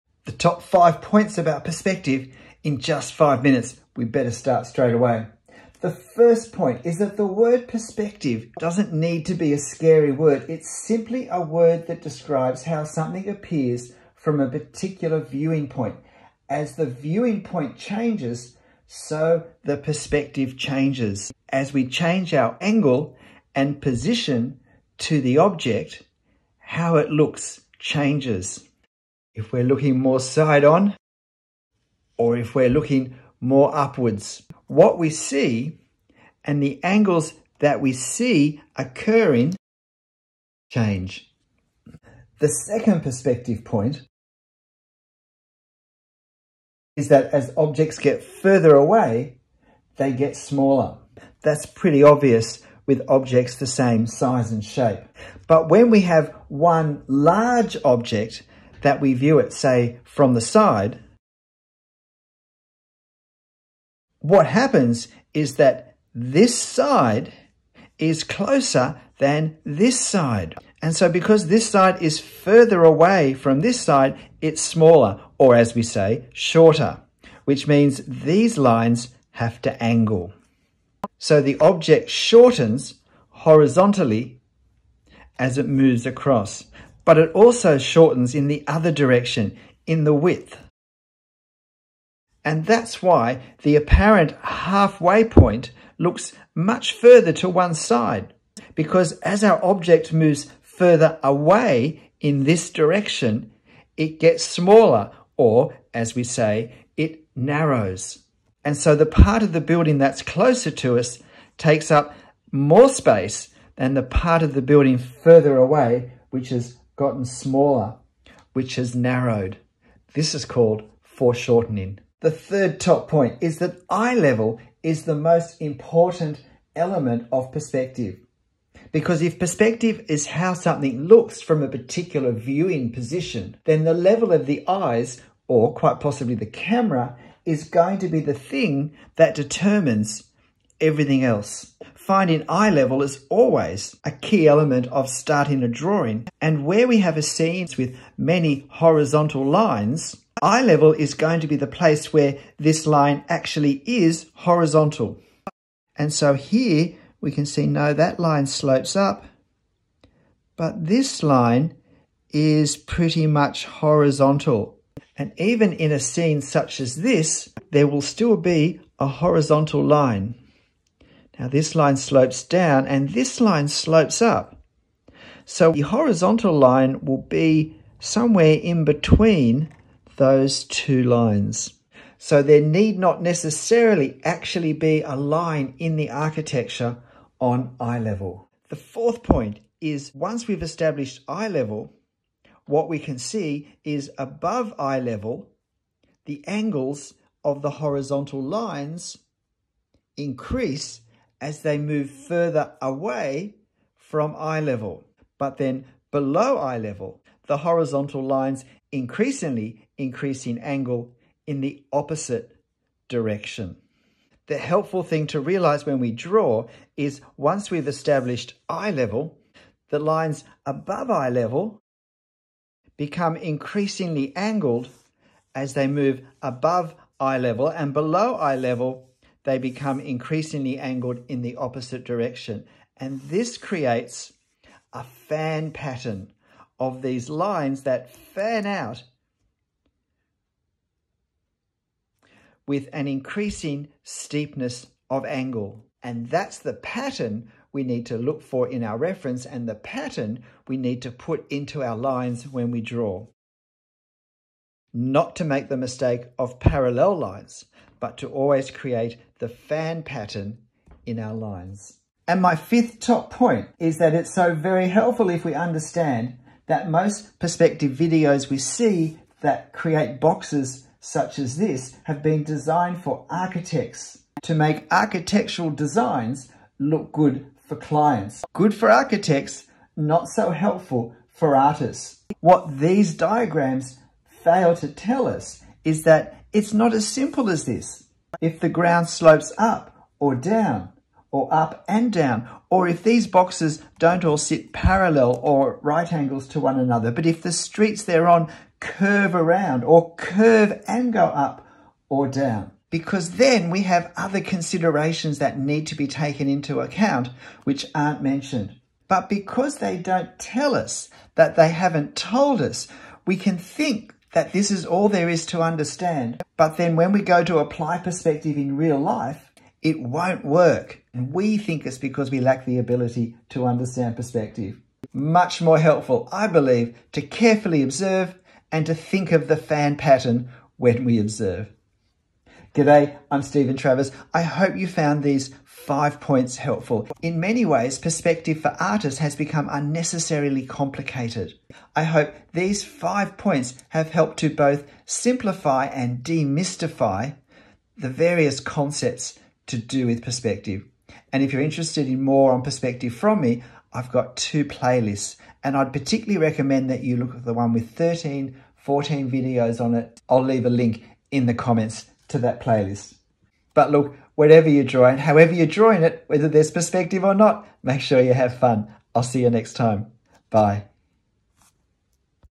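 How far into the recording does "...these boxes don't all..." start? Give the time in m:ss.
4:53.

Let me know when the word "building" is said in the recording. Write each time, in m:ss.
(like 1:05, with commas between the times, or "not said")
1:49, 1:54.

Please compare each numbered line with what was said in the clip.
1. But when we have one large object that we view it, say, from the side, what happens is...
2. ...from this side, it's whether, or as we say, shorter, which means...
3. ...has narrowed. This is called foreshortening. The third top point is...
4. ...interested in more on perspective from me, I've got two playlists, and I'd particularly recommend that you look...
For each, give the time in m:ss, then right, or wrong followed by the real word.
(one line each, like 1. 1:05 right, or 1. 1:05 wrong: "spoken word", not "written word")
1. 0:55 right
2. 1:13 wrong: "smaller", not "whether"
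3. 1:58 right
4. 5:51 right.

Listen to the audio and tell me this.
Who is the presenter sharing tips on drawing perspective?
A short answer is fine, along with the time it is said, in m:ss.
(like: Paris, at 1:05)
Stephen Travers, at 5:33.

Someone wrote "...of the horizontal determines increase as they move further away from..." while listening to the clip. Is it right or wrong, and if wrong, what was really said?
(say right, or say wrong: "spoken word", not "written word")
wrong: "lines", not "determines".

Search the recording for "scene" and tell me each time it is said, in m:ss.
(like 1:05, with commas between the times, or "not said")
2:27, 2:46.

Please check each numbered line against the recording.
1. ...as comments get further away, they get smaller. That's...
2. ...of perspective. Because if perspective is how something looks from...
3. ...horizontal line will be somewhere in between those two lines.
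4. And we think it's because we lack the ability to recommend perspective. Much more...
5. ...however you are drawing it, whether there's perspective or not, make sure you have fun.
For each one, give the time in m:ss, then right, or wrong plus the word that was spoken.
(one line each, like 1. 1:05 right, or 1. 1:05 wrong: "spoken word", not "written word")
1. 0:47 wrong: "objects", not "comments"
2. 2:07 right
3. 2:55 right
4. 5:21 wrong: "understand", not "recommend"
5. 6:05 right.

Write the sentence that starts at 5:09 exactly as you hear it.
But because they don't tell us that they haven't told us, we can think that this is all there is to understand.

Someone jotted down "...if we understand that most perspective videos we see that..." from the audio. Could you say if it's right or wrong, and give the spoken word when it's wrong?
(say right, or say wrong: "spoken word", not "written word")
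right.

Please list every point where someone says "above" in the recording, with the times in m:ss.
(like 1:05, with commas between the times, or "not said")
3:14, 3:40, 3:46.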